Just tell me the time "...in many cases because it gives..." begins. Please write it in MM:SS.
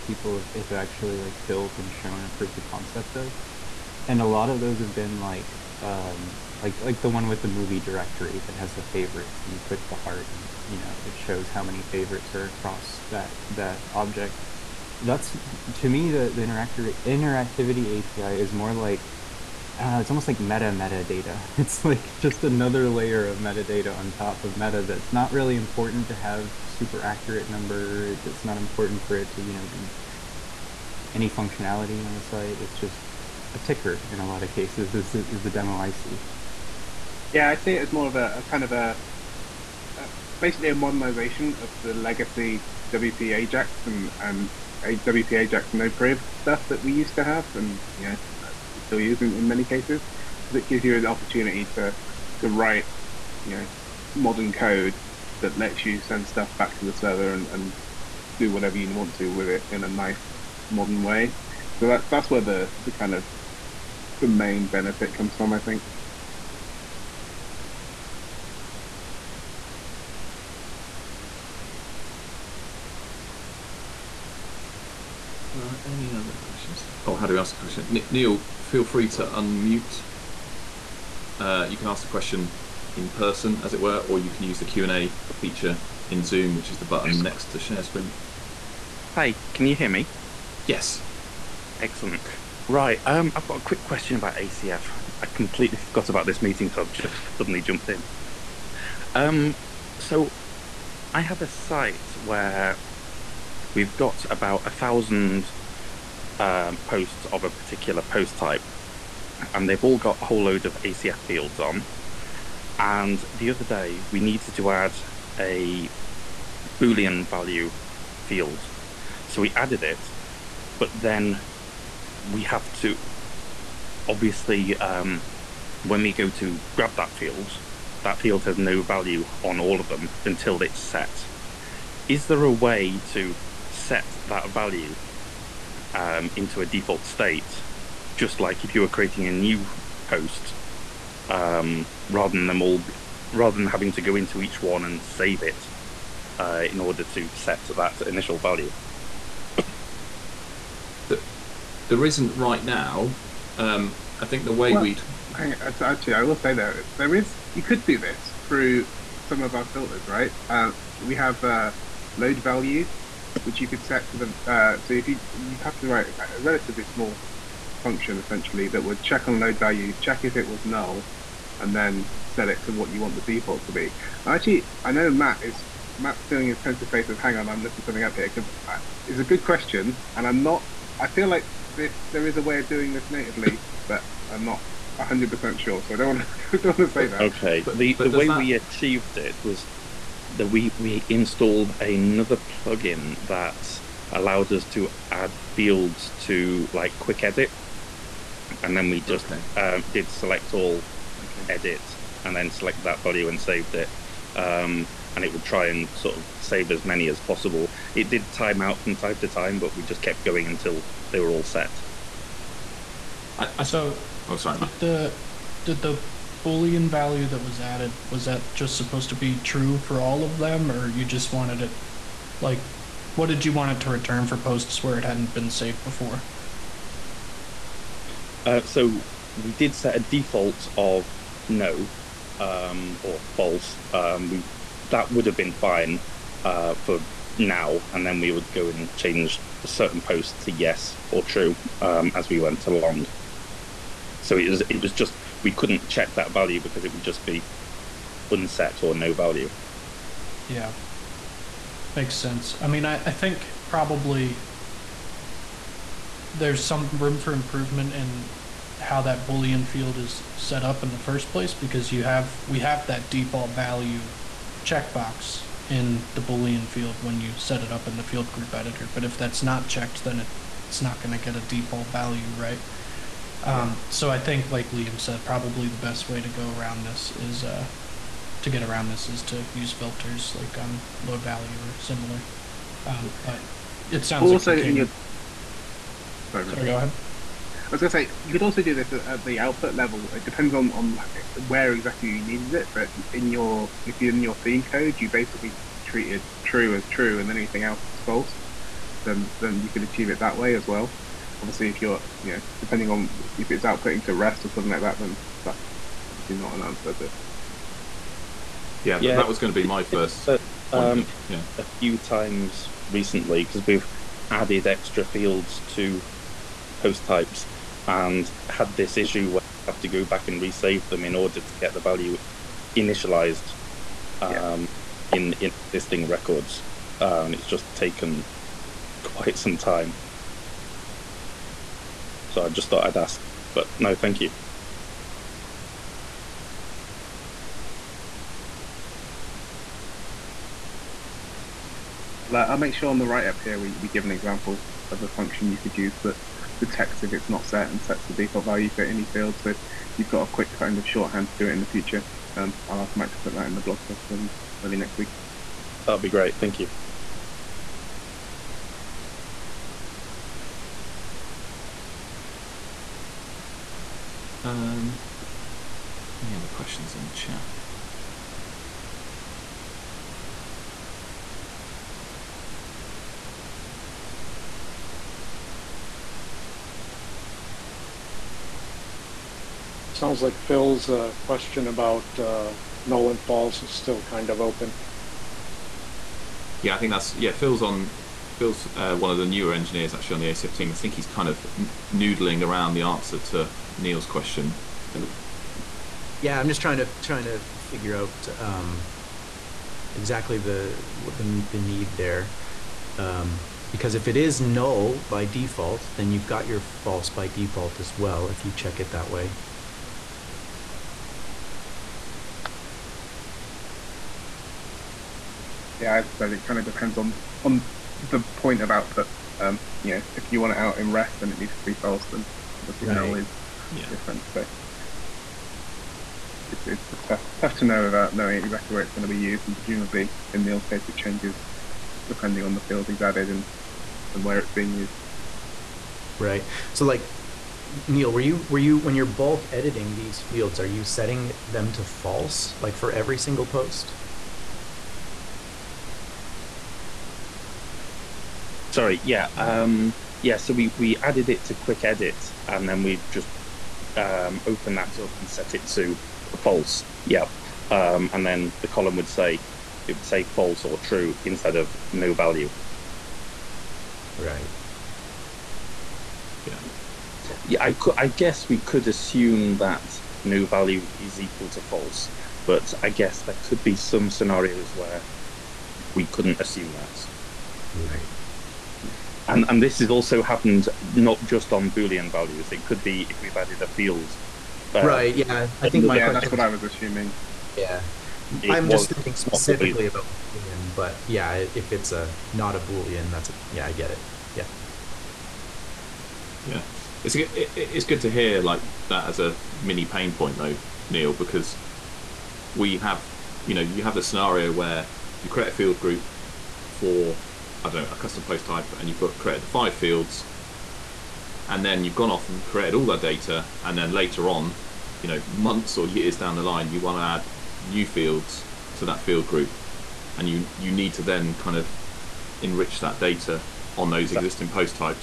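00:49.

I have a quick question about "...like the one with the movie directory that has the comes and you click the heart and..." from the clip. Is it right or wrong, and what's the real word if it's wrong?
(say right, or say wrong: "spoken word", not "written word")
wrong: "favorites", not "comes".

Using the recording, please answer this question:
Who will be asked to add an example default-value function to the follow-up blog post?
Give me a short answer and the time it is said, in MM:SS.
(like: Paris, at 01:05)
Mike, at 05:52.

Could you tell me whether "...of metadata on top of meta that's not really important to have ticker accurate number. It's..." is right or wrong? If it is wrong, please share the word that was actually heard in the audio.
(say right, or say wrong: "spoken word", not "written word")
wrong: "super", not "ticker".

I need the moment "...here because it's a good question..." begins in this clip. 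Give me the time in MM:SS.
02:58.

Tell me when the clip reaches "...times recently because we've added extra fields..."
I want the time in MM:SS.
05:11.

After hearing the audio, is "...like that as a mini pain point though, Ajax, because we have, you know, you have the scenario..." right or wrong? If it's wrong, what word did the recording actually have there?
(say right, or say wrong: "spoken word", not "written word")
wrong: "Neil", not "Ajax".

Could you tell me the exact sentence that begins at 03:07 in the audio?
Okay, but, the, but the way that...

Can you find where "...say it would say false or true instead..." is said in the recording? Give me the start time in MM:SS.
07:39.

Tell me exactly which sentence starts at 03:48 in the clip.
Uh, so we did set a default of no um, or false.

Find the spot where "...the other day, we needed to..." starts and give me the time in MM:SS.
01:53.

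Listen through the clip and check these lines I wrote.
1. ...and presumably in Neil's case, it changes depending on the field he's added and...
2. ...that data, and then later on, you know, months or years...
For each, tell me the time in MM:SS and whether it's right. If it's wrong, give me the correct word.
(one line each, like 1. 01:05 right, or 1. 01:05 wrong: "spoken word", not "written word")
1. 07:09 right
2. 08:32 right.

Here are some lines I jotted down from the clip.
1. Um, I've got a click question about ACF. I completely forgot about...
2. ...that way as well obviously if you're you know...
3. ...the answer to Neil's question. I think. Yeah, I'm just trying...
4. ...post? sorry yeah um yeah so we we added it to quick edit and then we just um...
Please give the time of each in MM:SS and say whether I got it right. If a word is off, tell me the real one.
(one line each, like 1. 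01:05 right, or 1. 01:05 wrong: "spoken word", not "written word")
1. 01:33 wrong: "quick", not "click"
2. 05:00 right
3. 06:32 right
4. 07:23 right.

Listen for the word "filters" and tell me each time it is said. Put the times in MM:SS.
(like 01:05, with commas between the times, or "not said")
02:39, 04:39.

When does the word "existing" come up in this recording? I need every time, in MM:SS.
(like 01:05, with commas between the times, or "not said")
05:25, 08:44.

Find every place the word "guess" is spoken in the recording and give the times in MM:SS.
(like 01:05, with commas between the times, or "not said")
07:48, 07:52.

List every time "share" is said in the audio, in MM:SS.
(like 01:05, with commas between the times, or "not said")
01:27.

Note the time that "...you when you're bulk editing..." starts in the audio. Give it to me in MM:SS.
07:18.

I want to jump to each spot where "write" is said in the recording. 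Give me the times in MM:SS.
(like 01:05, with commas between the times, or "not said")
00:52, 02:45, 05:43.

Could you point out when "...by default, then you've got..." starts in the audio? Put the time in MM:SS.
06:45.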